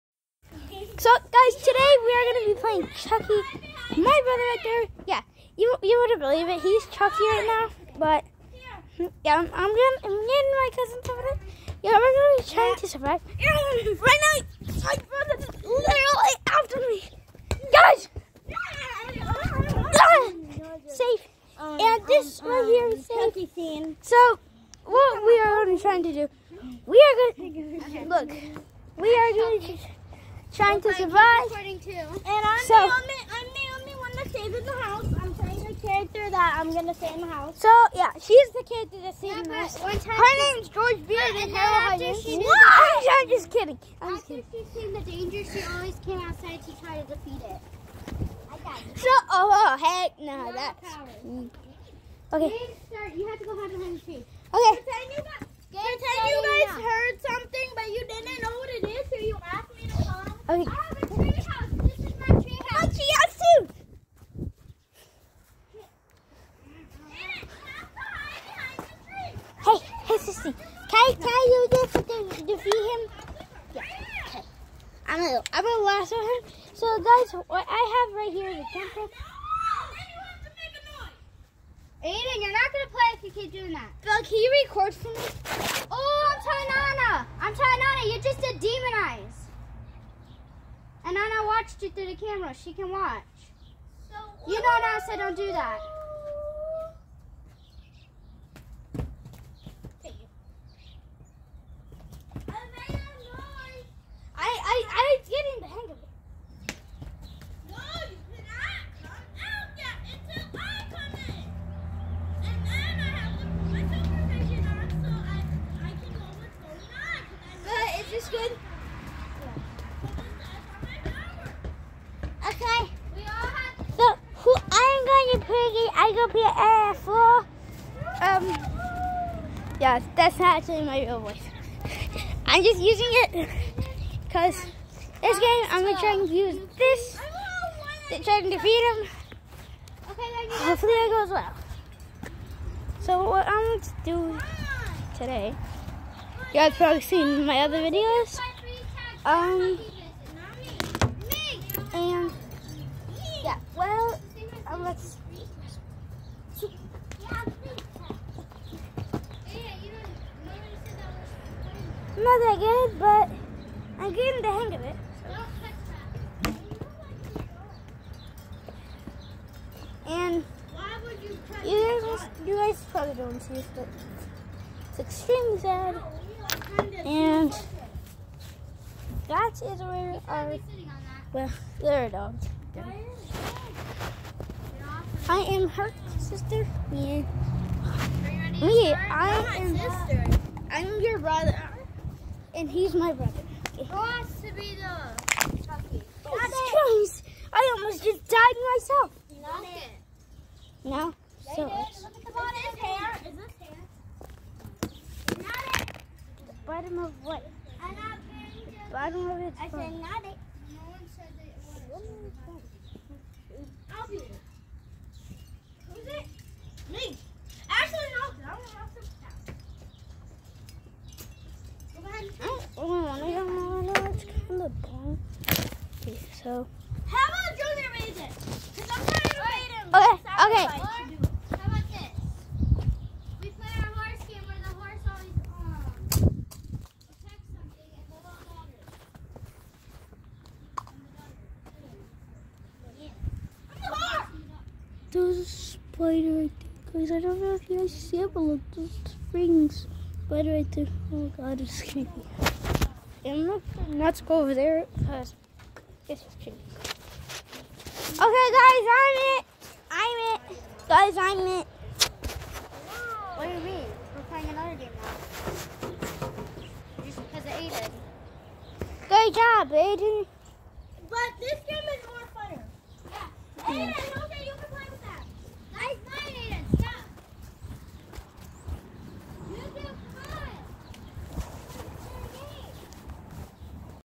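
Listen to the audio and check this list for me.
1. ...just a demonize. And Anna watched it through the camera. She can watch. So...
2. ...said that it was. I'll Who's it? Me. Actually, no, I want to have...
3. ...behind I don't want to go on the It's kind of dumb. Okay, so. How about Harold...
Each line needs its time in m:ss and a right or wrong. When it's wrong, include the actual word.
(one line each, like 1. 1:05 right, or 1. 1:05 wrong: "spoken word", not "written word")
1. 1:28 right
2. 3:31 right
3. 3:42 wrong: "Junior", not "Harold".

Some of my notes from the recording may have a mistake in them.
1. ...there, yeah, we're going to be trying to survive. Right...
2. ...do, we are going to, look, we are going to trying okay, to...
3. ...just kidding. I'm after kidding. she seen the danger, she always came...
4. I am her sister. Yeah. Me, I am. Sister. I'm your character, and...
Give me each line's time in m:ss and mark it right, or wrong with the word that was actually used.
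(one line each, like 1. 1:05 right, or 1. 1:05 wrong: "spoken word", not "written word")
1. 0:11 right
2. 0:26 right
3. 0:43 right
4. 3:05 wrong: "brother", not "character".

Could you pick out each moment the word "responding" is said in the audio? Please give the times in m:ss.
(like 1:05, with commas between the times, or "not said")
not said.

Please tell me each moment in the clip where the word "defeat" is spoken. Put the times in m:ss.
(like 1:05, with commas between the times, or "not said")
0:47, 1:12, 2:18.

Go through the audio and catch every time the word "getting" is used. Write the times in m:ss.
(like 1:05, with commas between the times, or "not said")
0:10, 2:44.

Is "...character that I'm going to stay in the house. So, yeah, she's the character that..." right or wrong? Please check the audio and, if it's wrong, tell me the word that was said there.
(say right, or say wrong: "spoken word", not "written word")
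right.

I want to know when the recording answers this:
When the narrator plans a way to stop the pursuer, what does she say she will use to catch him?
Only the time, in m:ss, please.
1:15.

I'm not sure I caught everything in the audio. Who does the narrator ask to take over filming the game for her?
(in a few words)
Bill.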